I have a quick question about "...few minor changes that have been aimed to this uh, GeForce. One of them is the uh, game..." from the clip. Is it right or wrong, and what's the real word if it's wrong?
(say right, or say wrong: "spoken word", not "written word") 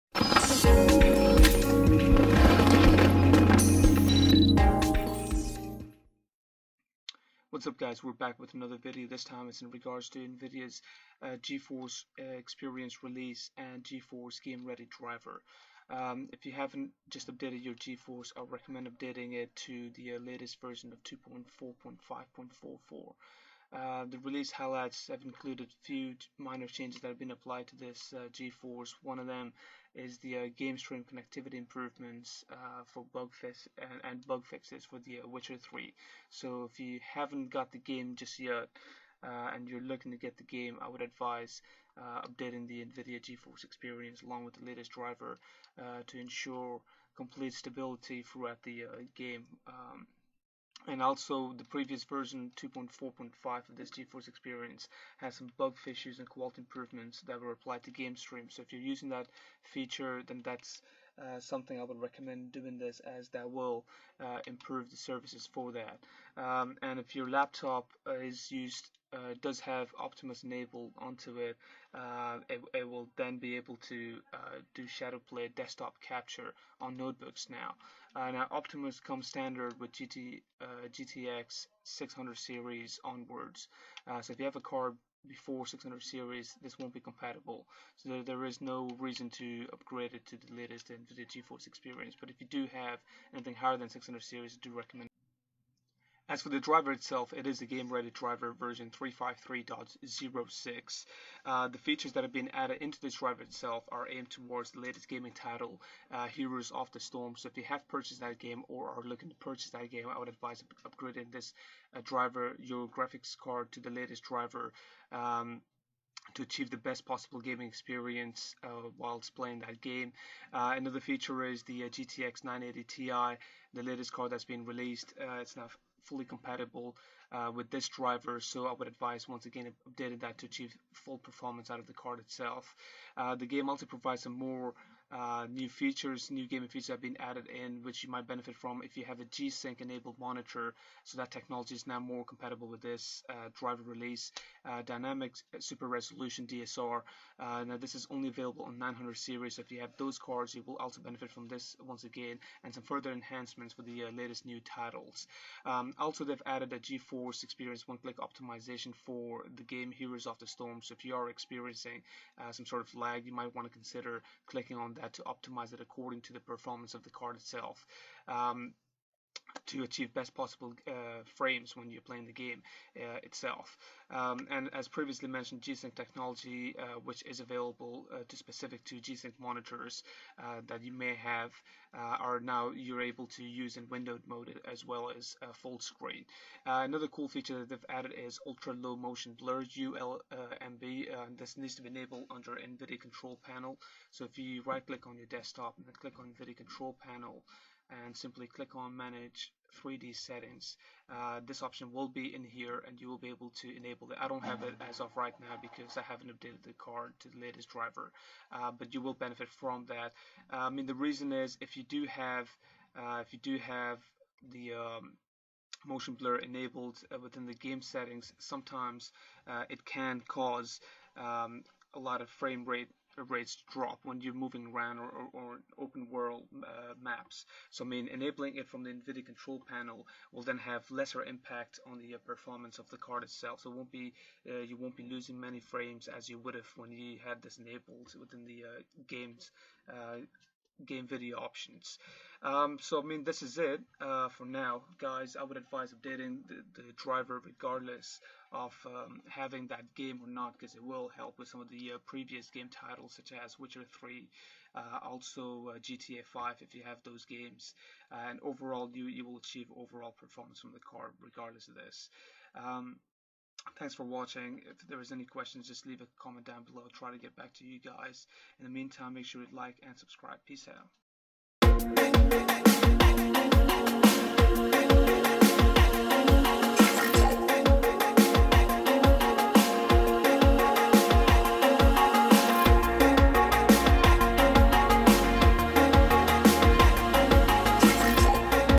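wrong: "applied", not "aimed".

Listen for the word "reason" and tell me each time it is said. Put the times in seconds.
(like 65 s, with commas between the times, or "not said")
88 s, 210 s.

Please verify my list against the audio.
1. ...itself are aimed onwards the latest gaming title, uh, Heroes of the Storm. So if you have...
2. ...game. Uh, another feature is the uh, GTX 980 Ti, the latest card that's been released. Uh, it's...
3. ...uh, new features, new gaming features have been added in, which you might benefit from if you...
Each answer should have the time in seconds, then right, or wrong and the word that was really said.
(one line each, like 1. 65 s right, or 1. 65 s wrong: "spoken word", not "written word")
1. 103 s wrong: "towards", not "onwards"
2. 119 s right
3. 135 s right.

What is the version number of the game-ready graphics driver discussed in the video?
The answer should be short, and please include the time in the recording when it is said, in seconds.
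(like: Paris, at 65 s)
353.06, at 98 s.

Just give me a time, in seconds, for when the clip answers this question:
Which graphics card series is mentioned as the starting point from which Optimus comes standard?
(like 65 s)
80 s.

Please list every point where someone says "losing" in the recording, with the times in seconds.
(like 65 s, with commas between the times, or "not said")
235 s.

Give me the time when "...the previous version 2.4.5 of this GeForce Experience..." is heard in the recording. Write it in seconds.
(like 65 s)
51 s.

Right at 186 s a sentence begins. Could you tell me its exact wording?
another cool feature that they've added is ultra low motion blur ULMB.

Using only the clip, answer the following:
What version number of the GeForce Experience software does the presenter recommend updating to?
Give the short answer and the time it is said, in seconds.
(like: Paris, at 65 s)
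2.4.5.44, at 21 s.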